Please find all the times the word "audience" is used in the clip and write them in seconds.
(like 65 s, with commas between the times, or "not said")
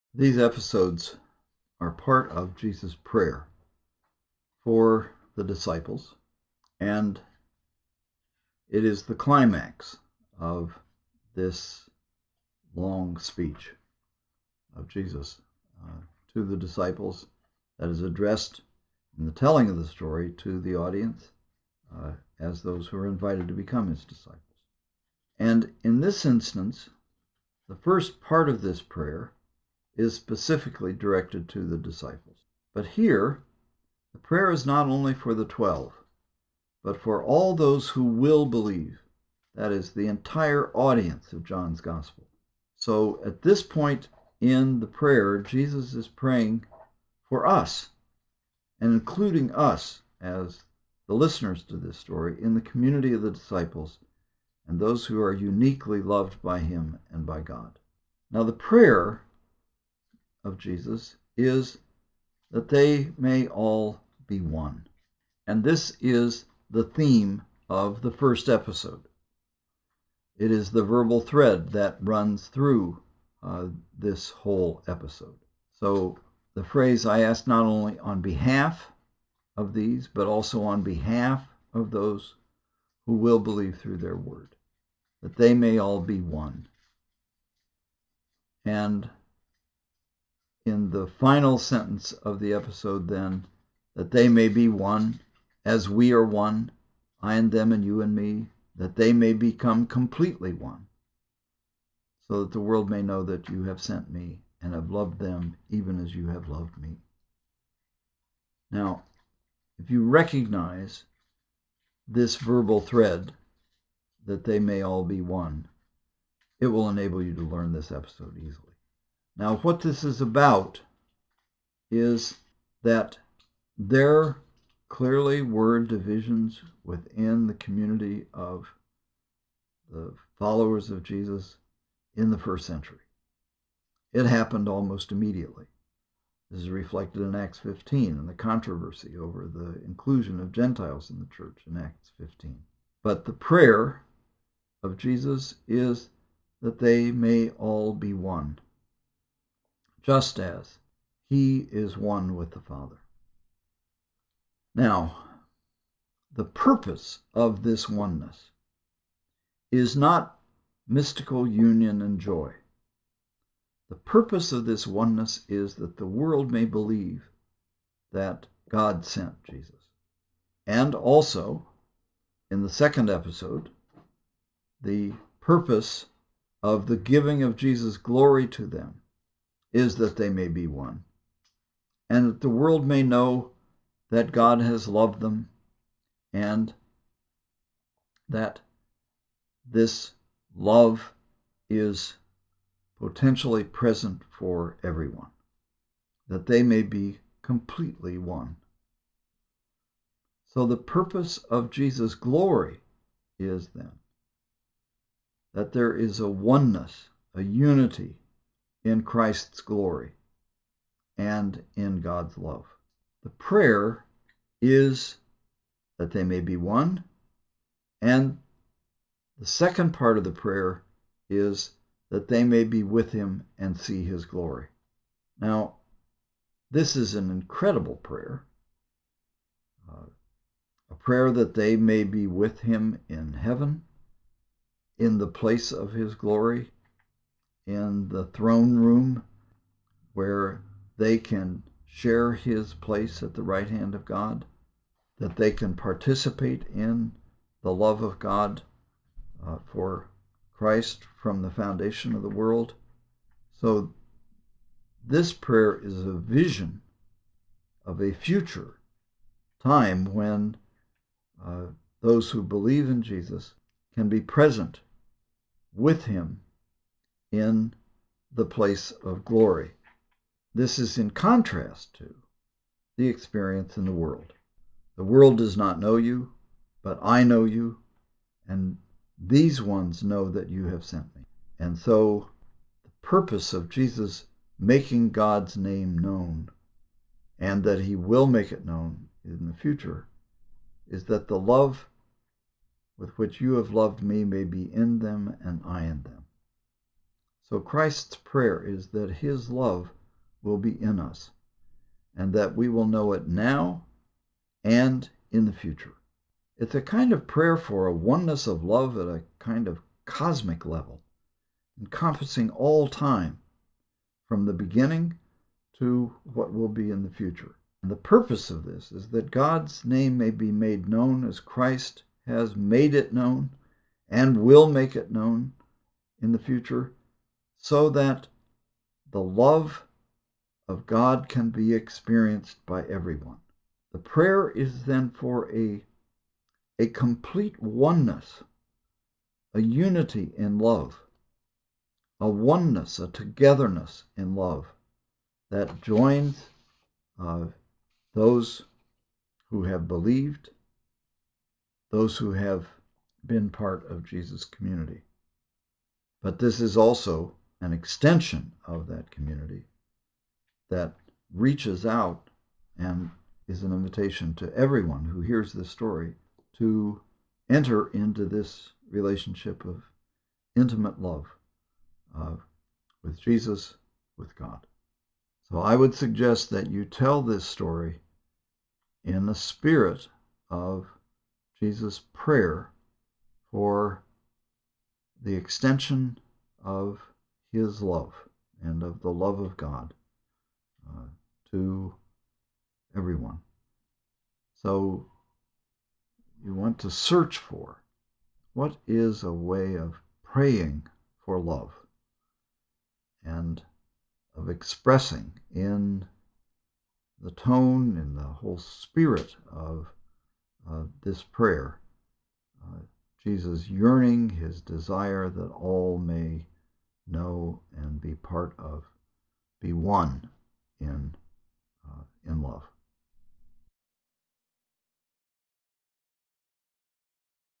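20 s, 40 s.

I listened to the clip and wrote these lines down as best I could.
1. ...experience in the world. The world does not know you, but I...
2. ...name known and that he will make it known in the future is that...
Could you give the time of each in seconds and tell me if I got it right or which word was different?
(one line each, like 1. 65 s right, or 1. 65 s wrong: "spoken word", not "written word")
1. 273 s right
2. 285 s right.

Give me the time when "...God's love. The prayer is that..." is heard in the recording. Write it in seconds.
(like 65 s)
212 s.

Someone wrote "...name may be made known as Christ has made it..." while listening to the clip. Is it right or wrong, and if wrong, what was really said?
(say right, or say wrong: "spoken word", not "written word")
right.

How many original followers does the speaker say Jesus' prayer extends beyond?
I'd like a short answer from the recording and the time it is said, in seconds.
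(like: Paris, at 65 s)
12, at 35 s.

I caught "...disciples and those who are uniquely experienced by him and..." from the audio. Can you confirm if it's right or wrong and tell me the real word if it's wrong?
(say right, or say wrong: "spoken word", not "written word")
wrong: "loved", not "experienced".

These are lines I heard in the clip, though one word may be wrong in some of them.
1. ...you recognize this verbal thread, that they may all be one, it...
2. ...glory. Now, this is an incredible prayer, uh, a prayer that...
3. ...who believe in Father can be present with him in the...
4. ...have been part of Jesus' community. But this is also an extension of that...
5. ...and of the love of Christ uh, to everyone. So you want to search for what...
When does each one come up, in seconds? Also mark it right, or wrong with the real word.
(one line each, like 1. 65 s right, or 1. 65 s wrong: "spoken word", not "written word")
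1. 109 s right
2. 224 s right
3. 262 s wrong: "Jesus", not "Father"
4. 352 s right
5. 388 s wrong: "God", not "Christ".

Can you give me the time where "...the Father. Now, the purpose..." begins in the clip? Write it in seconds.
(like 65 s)
152 s.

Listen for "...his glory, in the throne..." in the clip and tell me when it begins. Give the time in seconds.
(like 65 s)
235 s.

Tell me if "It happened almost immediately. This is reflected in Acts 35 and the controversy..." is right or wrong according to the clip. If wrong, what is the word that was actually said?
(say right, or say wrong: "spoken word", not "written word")
wrong: "15", not "35".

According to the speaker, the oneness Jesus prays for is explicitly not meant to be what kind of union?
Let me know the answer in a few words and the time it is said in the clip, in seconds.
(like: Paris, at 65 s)
Mystical union, at 160 s.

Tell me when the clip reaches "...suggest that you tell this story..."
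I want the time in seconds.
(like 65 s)
375 s.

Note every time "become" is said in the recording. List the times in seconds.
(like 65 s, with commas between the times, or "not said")
23 s, 99 s.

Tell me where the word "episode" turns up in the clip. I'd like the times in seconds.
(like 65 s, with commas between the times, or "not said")
0 s, 68 s, 74 s, 92 s, 117 s, 173 s.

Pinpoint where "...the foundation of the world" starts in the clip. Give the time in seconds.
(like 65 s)
251 s.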